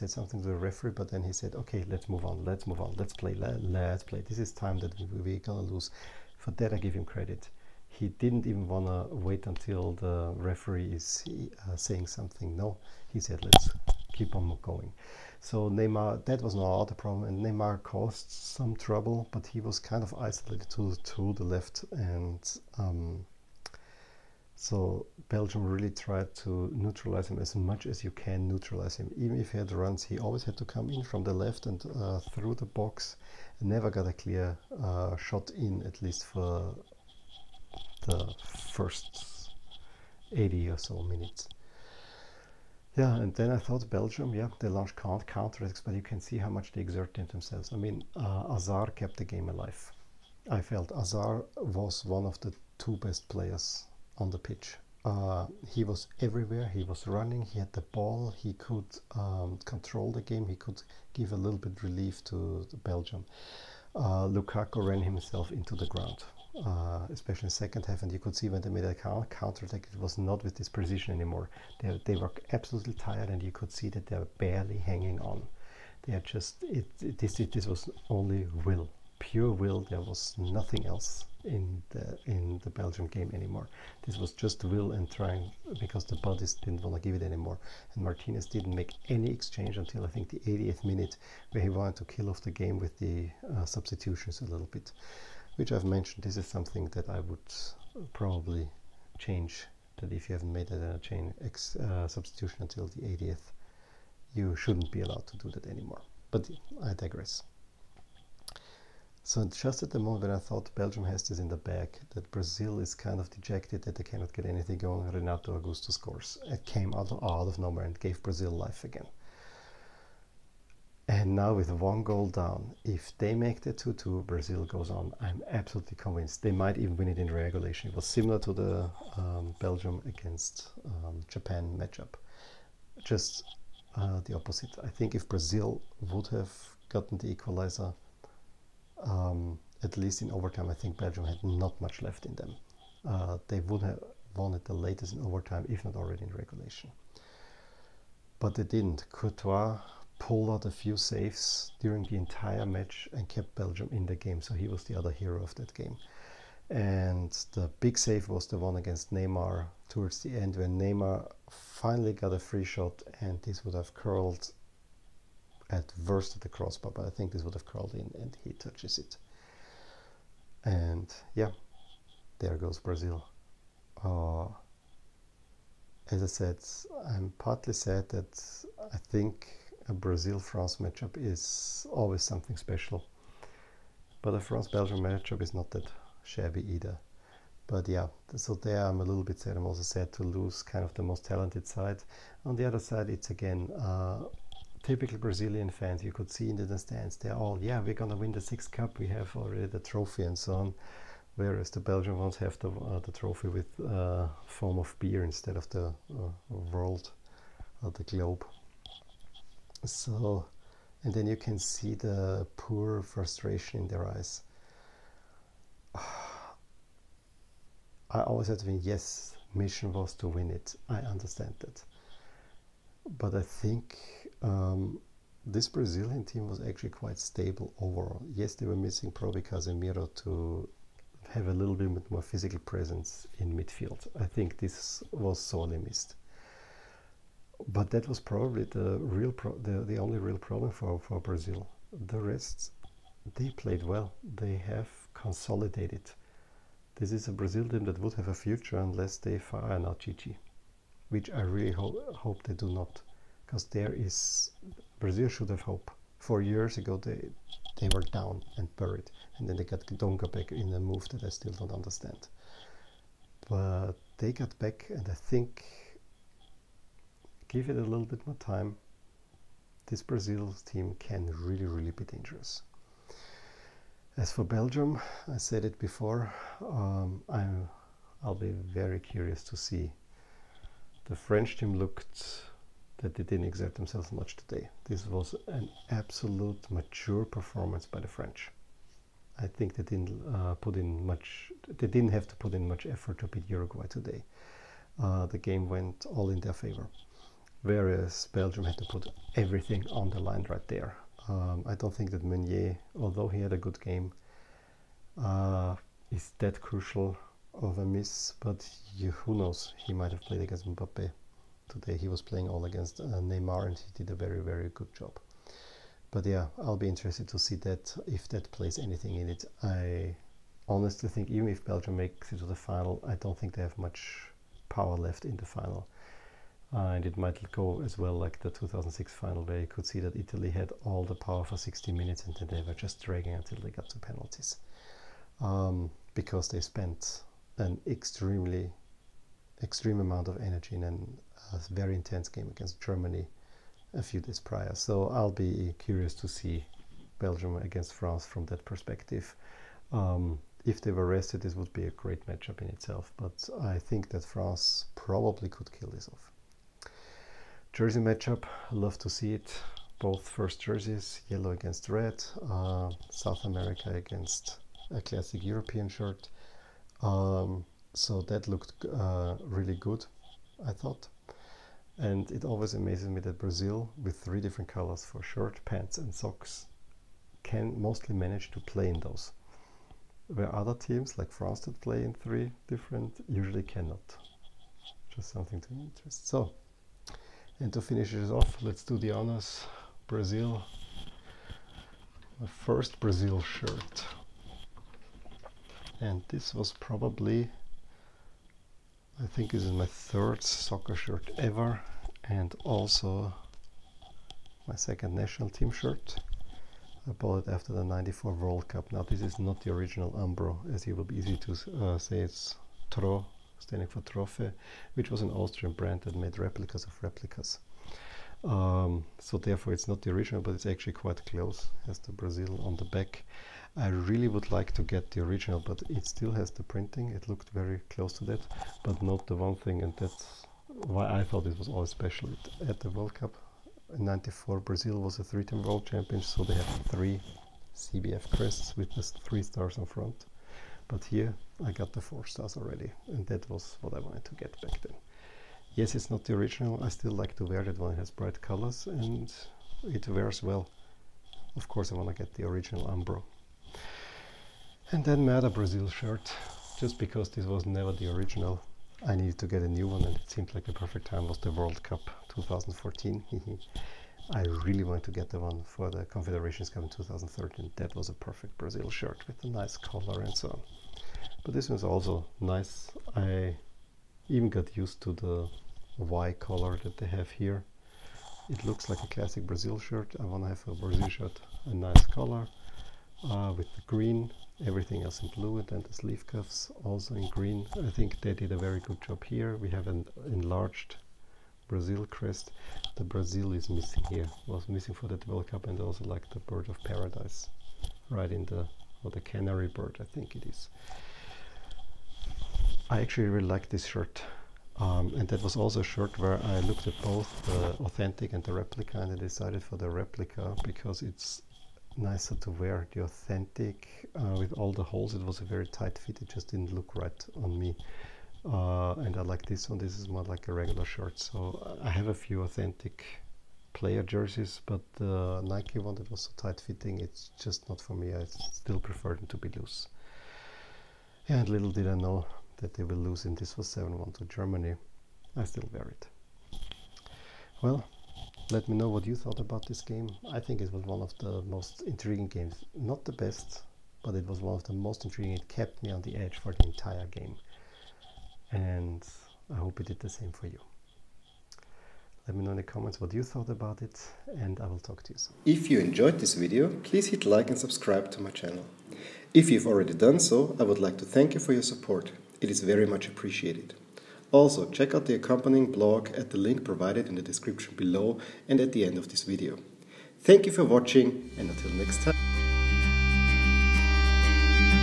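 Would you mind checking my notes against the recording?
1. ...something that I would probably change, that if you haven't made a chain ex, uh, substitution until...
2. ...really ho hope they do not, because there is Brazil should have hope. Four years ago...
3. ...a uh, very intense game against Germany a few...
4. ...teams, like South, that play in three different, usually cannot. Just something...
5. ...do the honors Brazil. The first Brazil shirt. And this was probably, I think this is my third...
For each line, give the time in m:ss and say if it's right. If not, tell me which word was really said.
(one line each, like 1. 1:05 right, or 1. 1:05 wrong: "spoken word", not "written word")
1. 1:36 right
2. 4:11 right
3. 5:41 right
4. 6:20 wrong: "France", not "South"
5. 6:28 right.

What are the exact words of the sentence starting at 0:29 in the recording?
Even if he had runs, he always had to come in from the left and uh, through the box.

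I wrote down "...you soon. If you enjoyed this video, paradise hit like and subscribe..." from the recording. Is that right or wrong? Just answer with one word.
wrong.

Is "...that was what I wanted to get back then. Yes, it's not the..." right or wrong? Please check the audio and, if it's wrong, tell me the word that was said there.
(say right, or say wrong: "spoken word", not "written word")
right.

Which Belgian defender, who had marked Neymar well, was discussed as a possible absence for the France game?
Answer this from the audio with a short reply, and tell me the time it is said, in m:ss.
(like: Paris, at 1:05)
Meunier, at 5:01.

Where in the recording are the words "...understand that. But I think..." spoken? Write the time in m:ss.
3:41.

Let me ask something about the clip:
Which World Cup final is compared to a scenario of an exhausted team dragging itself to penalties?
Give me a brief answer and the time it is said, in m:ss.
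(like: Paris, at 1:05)
2006, at 5:28.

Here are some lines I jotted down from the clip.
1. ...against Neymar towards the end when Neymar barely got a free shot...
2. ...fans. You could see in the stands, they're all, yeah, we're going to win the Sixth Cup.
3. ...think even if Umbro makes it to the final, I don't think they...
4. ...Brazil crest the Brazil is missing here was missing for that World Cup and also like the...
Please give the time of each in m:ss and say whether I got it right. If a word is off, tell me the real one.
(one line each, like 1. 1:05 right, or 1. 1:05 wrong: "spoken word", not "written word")
1. 2:38 wrong: "finally", not "barely"
2. 3:15 right
3. 5:21 wrong: "Belgium", not "Umbro"
4. 8:11 right.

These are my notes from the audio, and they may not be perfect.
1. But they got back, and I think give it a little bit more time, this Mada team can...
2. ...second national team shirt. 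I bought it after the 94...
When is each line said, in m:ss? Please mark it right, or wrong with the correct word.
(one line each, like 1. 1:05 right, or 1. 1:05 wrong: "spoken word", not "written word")
1. 4:23 wrong: "Brazil", not "Mada"
2. 6:44 right.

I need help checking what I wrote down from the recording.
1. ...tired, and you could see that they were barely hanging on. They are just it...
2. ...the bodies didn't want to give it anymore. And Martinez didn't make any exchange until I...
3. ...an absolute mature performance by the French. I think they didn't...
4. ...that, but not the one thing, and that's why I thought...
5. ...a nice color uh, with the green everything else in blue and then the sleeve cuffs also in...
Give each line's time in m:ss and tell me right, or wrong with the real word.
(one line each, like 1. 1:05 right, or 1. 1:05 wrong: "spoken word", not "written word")
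1. 1:12 right
2. 1:26 right
3. 4:45 right
4. 7:08 right
5. 8:01 right.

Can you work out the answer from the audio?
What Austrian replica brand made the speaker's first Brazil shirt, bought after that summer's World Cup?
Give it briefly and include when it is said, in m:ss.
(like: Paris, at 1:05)
Tro, at 6:52.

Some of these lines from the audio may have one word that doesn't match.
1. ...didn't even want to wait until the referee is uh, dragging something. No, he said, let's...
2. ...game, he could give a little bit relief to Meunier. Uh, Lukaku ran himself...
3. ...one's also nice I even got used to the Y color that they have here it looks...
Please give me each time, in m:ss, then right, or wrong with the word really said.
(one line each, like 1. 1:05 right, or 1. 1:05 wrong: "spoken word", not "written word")
1. 0:08 wrong: "saying", not "dragging"
2. 1:00 wrong: "Belgium", not "Meunier"
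3. 7:51 right.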